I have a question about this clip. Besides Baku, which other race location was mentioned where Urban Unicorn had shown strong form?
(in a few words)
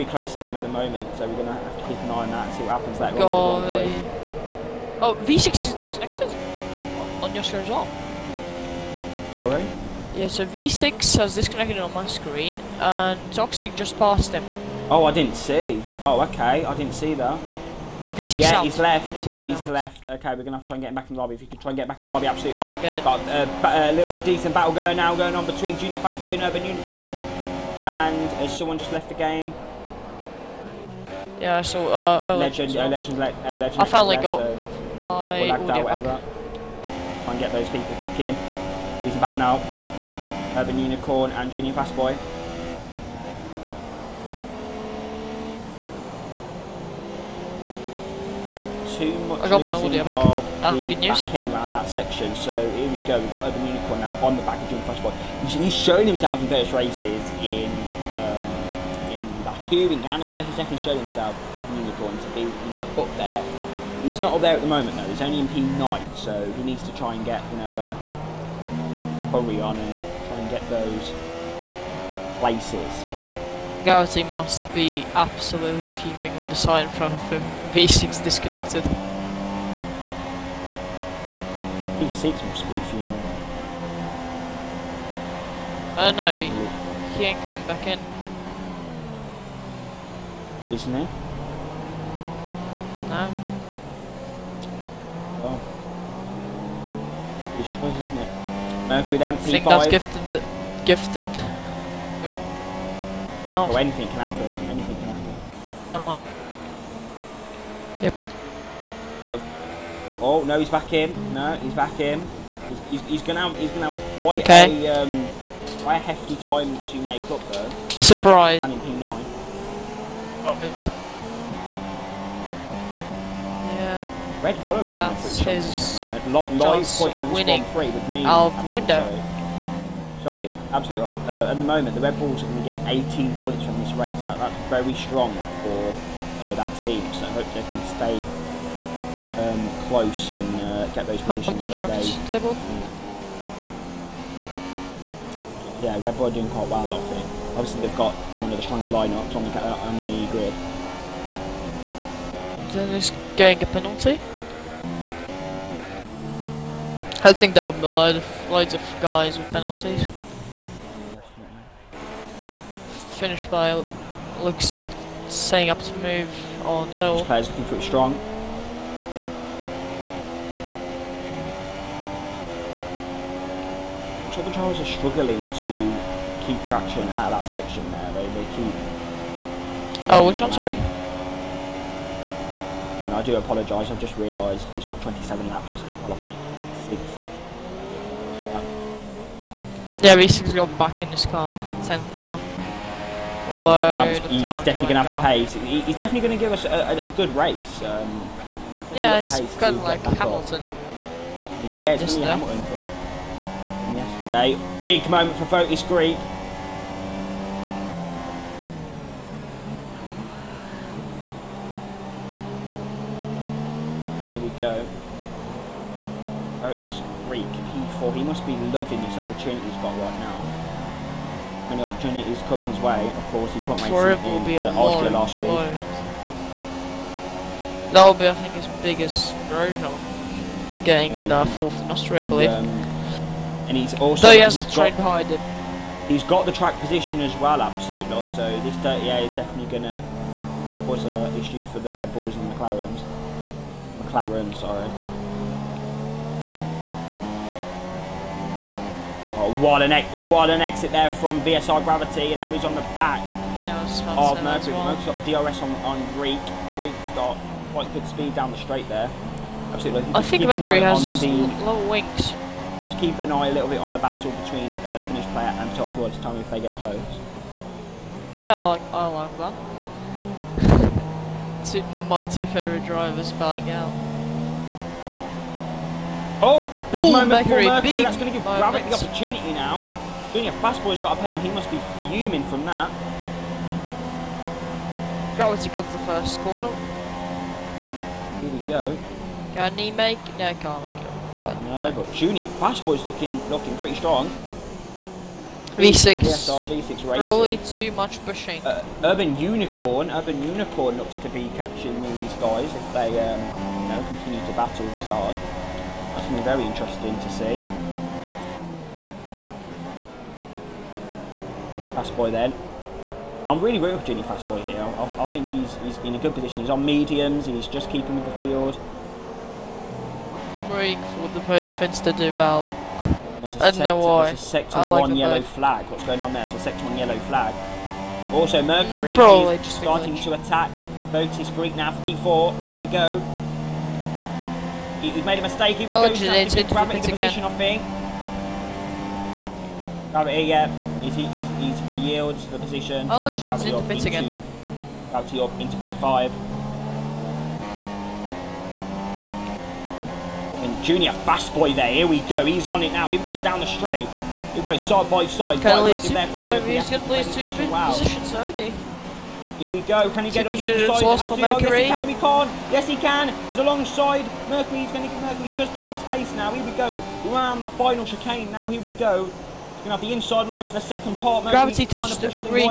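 Canada.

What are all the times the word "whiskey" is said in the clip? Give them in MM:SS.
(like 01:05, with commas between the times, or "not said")
not said.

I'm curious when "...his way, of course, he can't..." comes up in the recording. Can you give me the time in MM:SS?
03:42.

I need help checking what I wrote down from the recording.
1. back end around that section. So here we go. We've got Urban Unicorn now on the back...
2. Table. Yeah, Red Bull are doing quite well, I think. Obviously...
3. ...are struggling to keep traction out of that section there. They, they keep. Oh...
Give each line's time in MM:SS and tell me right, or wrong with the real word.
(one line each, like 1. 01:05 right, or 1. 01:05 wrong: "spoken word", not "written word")
1. 00:51 right
2. 02:22 right
3. 02:54 right.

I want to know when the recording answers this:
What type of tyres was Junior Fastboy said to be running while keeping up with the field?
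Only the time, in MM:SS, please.
05:16.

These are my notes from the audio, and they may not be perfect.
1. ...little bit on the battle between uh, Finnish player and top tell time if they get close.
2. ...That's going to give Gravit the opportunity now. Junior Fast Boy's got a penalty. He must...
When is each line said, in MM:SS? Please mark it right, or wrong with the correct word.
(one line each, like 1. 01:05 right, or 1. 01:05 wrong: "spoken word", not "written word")
1. 04:23 right
2. 04:38 right.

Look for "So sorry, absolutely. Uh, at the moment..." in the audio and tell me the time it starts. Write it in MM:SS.
02:09.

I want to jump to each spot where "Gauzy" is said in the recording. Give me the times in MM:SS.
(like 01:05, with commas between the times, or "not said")
01:13.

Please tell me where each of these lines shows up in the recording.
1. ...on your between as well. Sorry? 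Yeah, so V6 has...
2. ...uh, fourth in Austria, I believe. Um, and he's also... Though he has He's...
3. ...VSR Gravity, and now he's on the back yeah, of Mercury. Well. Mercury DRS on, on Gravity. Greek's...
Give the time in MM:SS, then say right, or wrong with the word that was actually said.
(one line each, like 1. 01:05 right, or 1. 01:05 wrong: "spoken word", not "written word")
1. 00:07 wrong: "screen", not "between"
2. 03:51 right
3. 04:11 wrong: "Greek", not "Gravity".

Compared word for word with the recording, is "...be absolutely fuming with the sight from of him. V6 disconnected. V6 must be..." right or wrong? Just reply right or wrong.
right.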